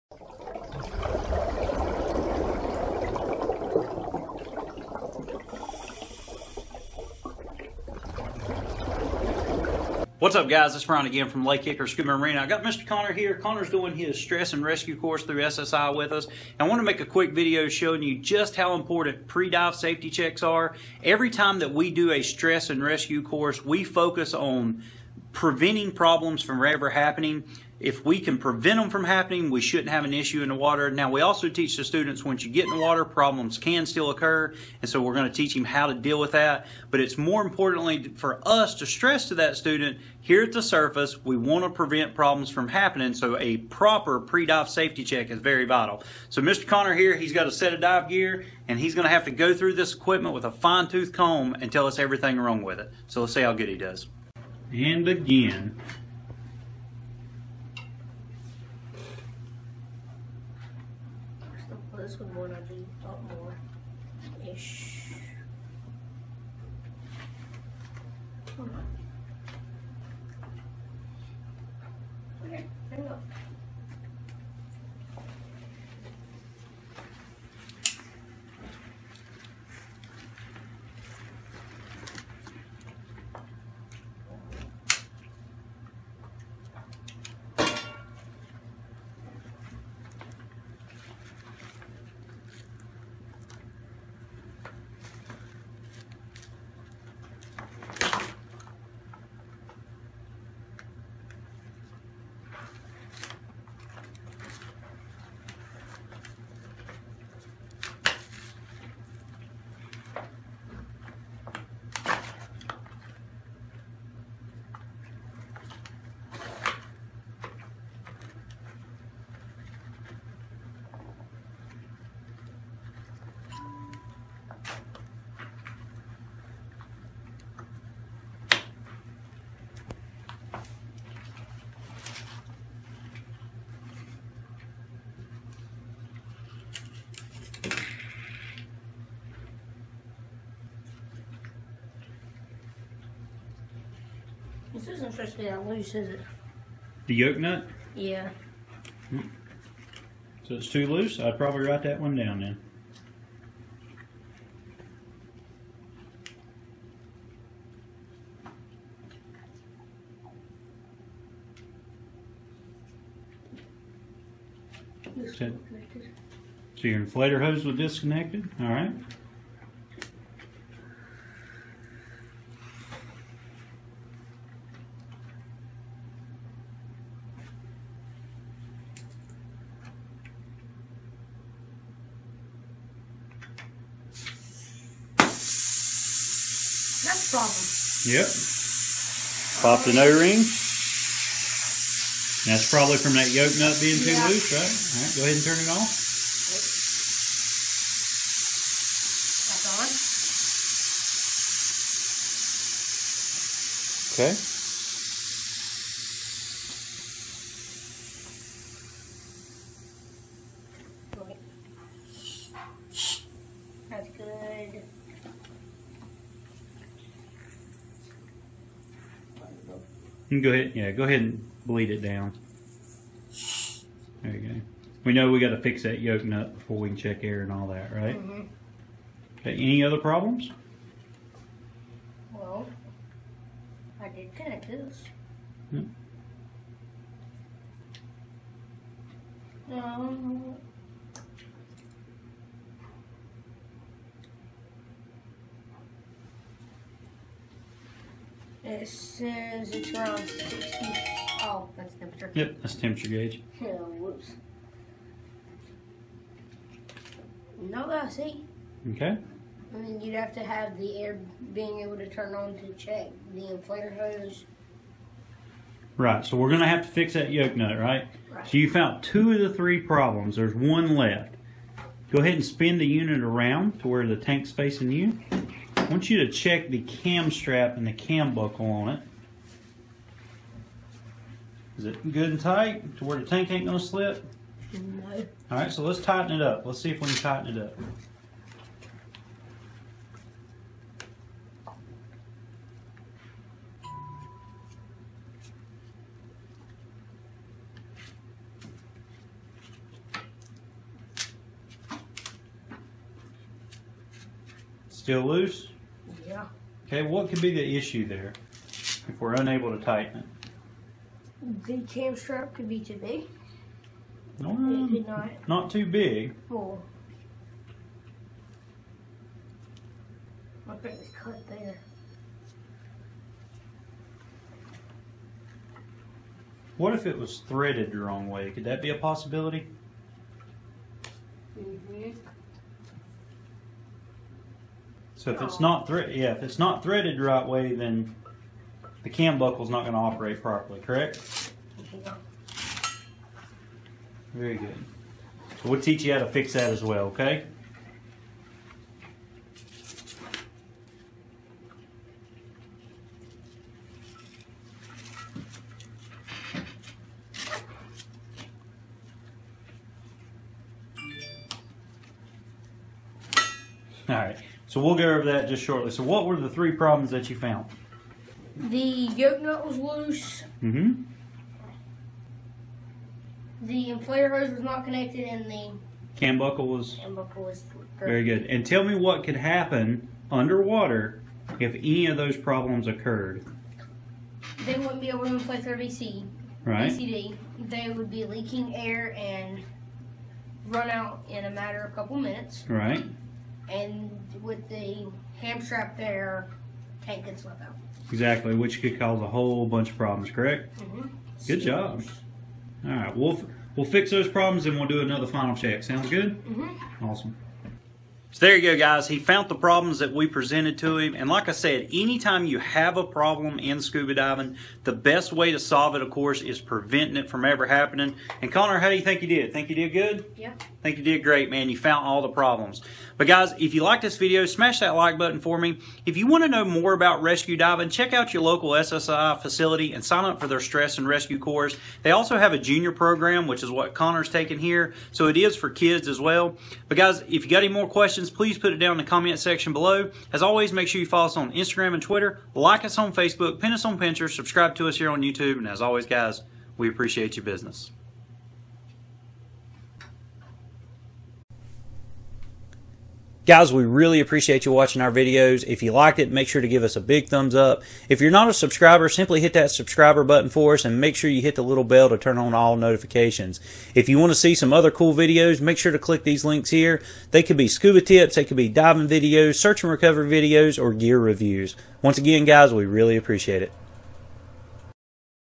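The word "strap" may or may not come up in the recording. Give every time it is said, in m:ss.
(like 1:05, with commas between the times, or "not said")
4:37, 5:12, 6:35.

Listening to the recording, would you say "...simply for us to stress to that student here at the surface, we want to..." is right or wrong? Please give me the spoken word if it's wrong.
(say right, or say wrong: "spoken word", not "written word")
wrong: "importantly", not "simply".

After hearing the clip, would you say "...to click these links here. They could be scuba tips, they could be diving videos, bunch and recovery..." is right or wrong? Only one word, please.
wrong.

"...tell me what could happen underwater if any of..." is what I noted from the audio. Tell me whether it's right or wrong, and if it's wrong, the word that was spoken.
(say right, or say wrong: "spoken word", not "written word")
right.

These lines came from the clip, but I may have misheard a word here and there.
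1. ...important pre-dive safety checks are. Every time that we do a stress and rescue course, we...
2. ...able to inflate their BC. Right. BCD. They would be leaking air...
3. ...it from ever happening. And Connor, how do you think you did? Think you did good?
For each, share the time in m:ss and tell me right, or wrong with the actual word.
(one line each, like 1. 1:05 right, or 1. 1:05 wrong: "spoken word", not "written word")
1. 0:18 right
2. 6:25 right
3. 6:57 right.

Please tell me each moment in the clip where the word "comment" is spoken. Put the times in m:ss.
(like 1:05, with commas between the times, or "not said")
7:19.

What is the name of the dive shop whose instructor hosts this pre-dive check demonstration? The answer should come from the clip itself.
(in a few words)
Lake Hickory Scuba Marine.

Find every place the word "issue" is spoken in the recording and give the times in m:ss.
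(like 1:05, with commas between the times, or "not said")
0:30, 5:07.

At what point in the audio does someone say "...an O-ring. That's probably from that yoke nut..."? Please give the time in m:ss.
3:09.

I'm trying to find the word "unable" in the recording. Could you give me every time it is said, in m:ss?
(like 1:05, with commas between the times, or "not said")
5:09.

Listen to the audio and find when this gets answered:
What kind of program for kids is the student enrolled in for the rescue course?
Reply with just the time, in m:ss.
7:12.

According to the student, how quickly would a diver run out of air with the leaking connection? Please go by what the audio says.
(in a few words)
a couple minutes.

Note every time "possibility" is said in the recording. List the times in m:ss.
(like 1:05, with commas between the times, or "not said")
5:28.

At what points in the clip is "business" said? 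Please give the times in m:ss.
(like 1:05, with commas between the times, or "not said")
7:27.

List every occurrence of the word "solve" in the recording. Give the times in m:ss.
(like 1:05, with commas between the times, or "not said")
6:55.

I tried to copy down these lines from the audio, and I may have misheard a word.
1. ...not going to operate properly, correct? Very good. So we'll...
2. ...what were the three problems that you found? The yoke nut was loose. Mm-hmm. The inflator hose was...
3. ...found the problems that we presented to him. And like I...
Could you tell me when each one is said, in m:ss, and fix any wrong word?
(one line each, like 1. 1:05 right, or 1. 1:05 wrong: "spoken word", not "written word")
1. 5:39 right
2. 6:06 right
3. 6:49 right.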